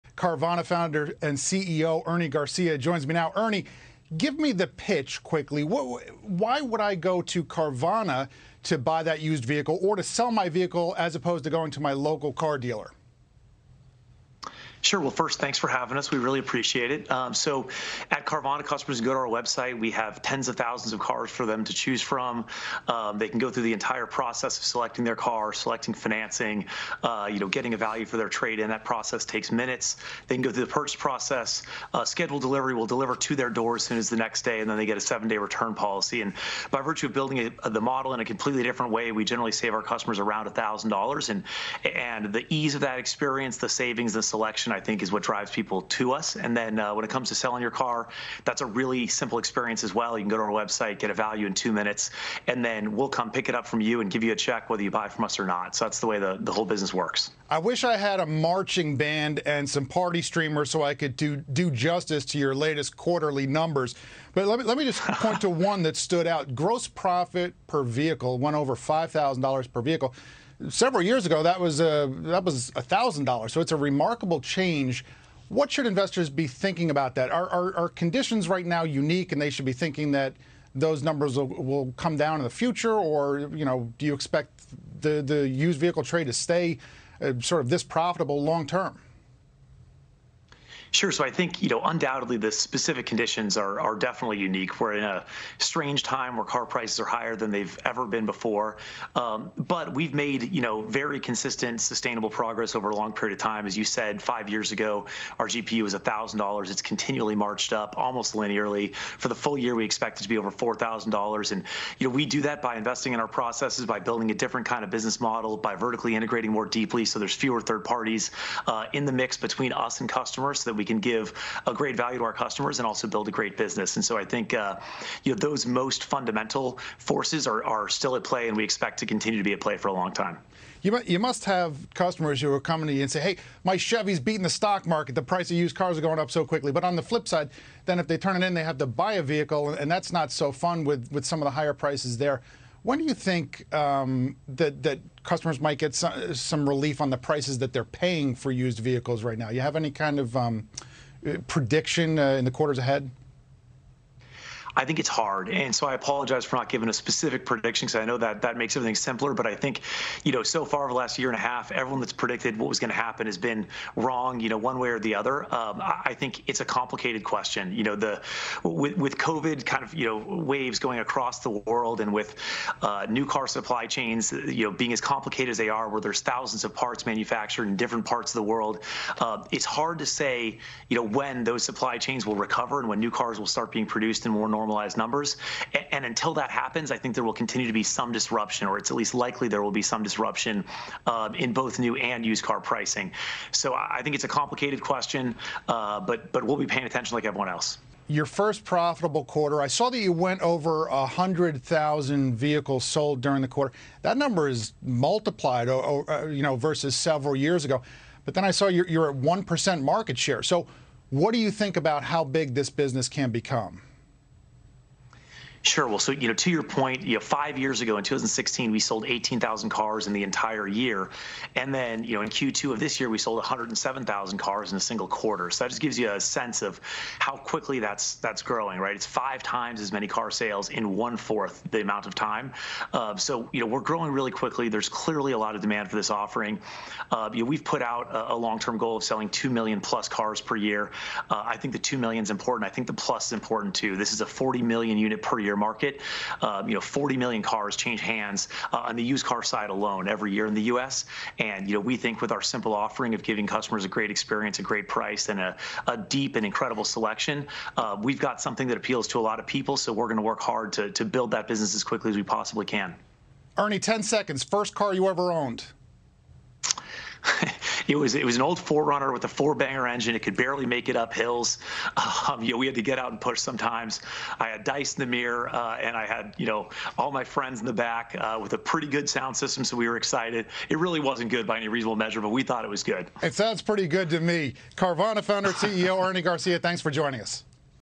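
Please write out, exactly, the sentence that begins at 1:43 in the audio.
As you said, five years ago, our GPU was $1,000.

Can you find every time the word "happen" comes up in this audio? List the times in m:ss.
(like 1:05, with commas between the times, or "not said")
2:42, 3:06.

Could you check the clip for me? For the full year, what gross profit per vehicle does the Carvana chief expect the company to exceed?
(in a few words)
$4,000.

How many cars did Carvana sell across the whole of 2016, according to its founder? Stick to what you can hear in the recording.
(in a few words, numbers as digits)
18,000.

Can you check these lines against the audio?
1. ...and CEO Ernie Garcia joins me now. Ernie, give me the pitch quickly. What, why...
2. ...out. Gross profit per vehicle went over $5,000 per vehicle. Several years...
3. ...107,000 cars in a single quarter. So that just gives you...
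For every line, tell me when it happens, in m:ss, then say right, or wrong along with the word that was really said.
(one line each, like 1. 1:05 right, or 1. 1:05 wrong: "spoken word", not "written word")
1. 0:01 right
2. 1:06 right
3. 3:43 right.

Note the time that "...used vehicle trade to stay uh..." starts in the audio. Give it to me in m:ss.
1:25.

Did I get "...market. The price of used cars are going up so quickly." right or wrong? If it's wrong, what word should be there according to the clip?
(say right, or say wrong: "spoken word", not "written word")
right.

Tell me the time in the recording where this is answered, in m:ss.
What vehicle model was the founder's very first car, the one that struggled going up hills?
4:28.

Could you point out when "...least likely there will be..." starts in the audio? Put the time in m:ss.
3:08.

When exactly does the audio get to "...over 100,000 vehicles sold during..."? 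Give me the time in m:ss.
3:20.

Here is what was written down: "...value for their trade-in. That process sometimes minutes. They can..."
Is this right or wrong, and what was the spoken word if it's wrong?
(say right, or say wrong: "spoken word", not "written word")
wrong: "takes", not "sometimes".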